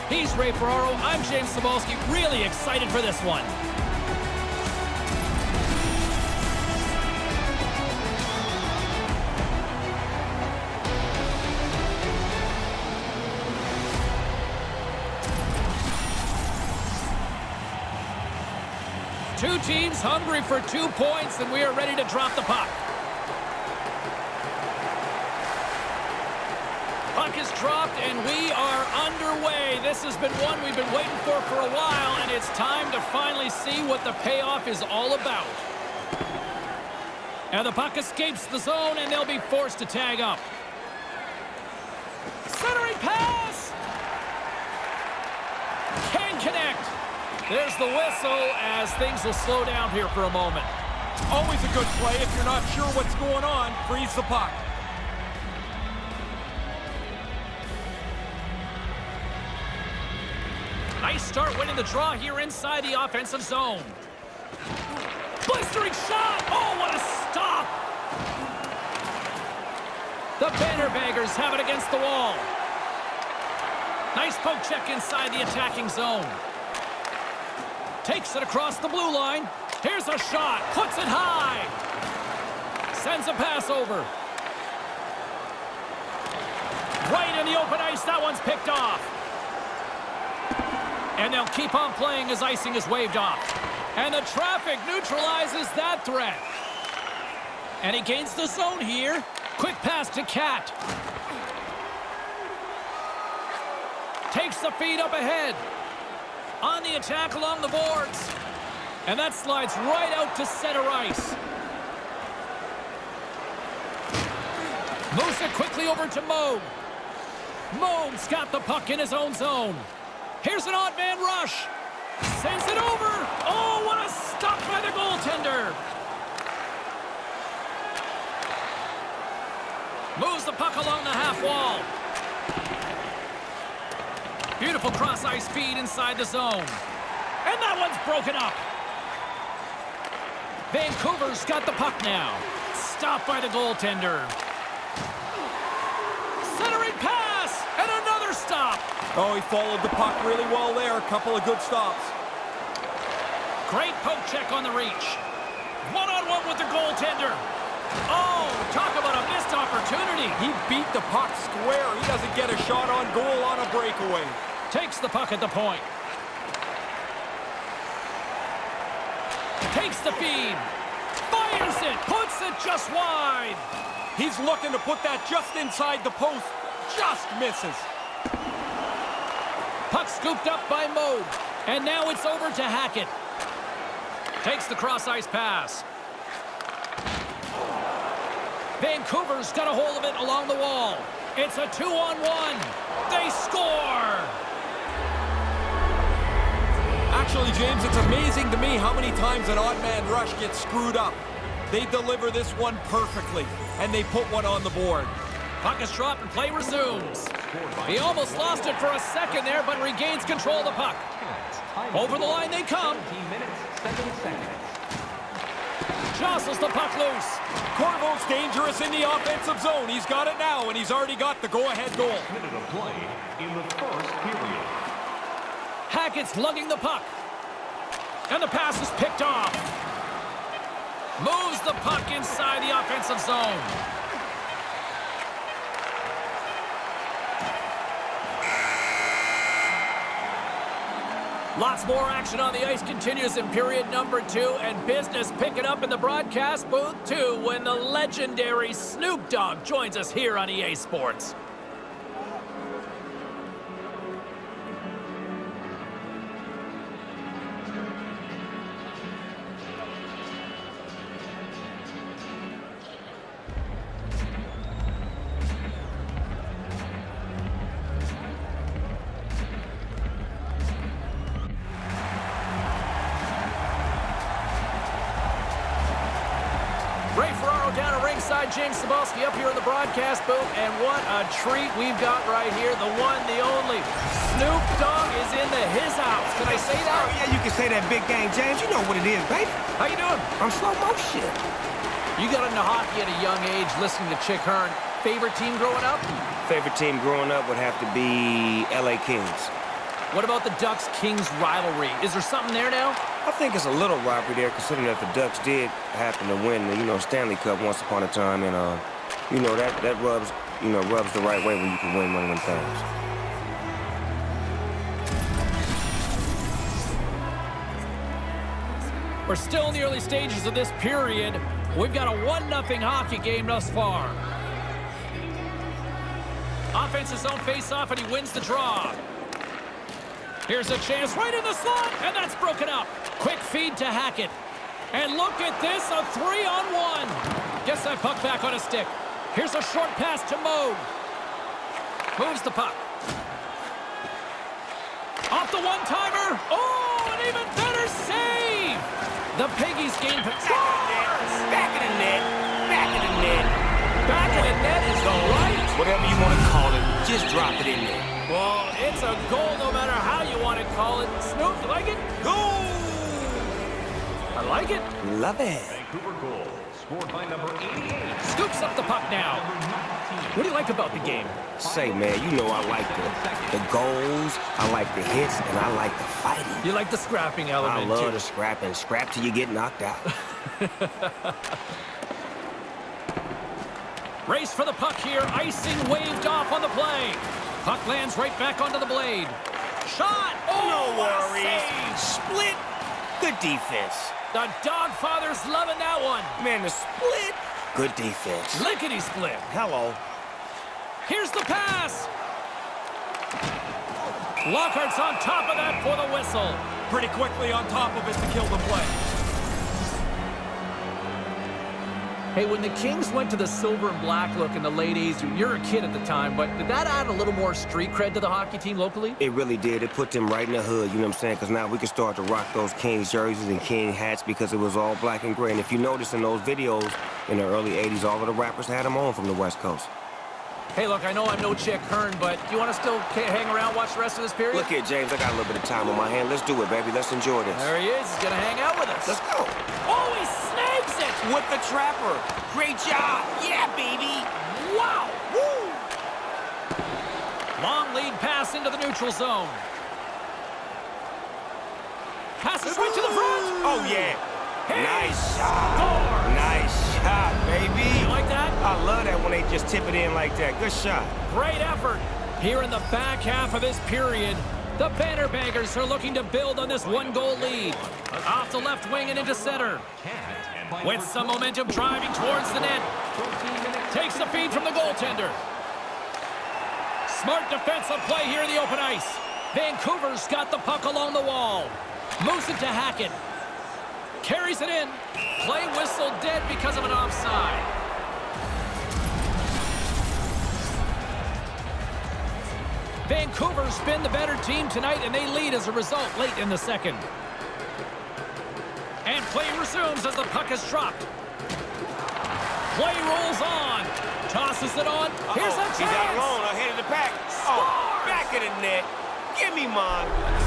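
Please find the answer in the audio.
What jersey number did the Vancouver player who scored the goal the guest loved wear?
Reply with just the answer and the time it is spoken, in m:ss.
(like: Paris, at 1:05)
88, at 6:07.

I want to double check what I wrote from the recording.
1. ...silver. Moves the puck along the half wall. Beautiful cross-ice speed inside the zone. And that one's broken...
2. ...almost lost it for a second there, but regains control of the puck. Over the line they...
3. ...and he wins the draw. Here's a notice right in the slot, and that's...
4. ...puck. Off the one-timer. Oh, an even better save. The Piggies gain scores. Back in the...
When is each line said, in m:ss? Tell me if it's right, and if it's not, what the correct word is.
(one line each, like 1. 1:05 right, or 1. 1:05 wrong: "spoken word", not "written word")
1. 2:04 wrong: "goaltender", not "silver"
2. 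3:27 right
3. 5:27 wrong: "chance", not "notice"
4. 5:42 right.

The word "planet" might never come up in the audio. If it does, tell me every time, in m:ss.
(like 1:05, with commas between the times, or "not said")
not said.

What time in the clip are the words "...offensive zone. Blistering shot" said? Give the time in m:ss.
1:03.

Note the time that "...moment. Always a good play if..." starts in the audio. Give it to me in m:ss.
0:50.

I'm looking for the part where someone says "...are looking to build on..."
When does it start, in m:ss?
7:45.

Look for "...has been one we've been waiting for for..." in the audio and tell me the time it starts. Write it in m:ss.
0:30.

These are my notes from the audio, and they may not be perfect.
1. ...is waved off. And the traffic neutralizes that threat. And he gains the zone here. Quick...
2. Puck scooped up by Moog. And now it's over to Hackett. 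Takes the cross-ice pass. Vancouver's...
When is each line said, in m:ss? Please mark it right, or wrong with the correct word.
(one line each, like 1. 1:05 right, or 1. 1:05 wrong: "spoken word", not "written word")
1. 1:32 right
2. 2:59 right.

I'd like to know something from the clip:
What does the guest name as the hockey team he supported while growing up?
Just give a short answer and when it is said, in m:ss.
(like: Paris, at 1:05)
L.A. Kings, at 4:58.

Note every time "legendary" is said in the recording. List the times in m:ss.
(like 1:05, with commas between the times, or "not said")
4:07.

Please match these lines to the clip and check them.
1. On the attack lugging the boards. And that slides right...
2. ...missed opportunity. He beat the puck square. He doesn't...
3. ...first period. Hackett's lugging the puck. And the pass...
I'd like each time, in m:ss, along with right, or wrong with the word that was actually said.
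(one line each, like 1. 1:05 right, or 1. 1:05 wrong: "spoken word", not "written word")
1. 1:46 wrong: "along", not "lugging"
2. 2:39 right
3. 3:43 right.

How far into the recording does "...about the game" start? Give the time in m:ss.
6:10.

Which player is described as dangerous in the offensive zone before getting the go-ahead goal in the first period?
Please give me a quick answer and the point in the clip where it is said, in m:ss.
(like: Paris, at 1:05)
Corvo, at 3:37.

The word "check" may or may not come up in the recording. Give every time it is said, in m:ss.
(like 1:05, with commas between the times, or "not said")
1:14, 2:34.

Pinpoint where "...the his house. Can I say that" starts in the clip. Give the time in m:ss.
4:45.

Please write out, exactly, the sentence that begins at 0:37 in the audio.
Now the puck escapes the zone, and they'll be forced to tag up.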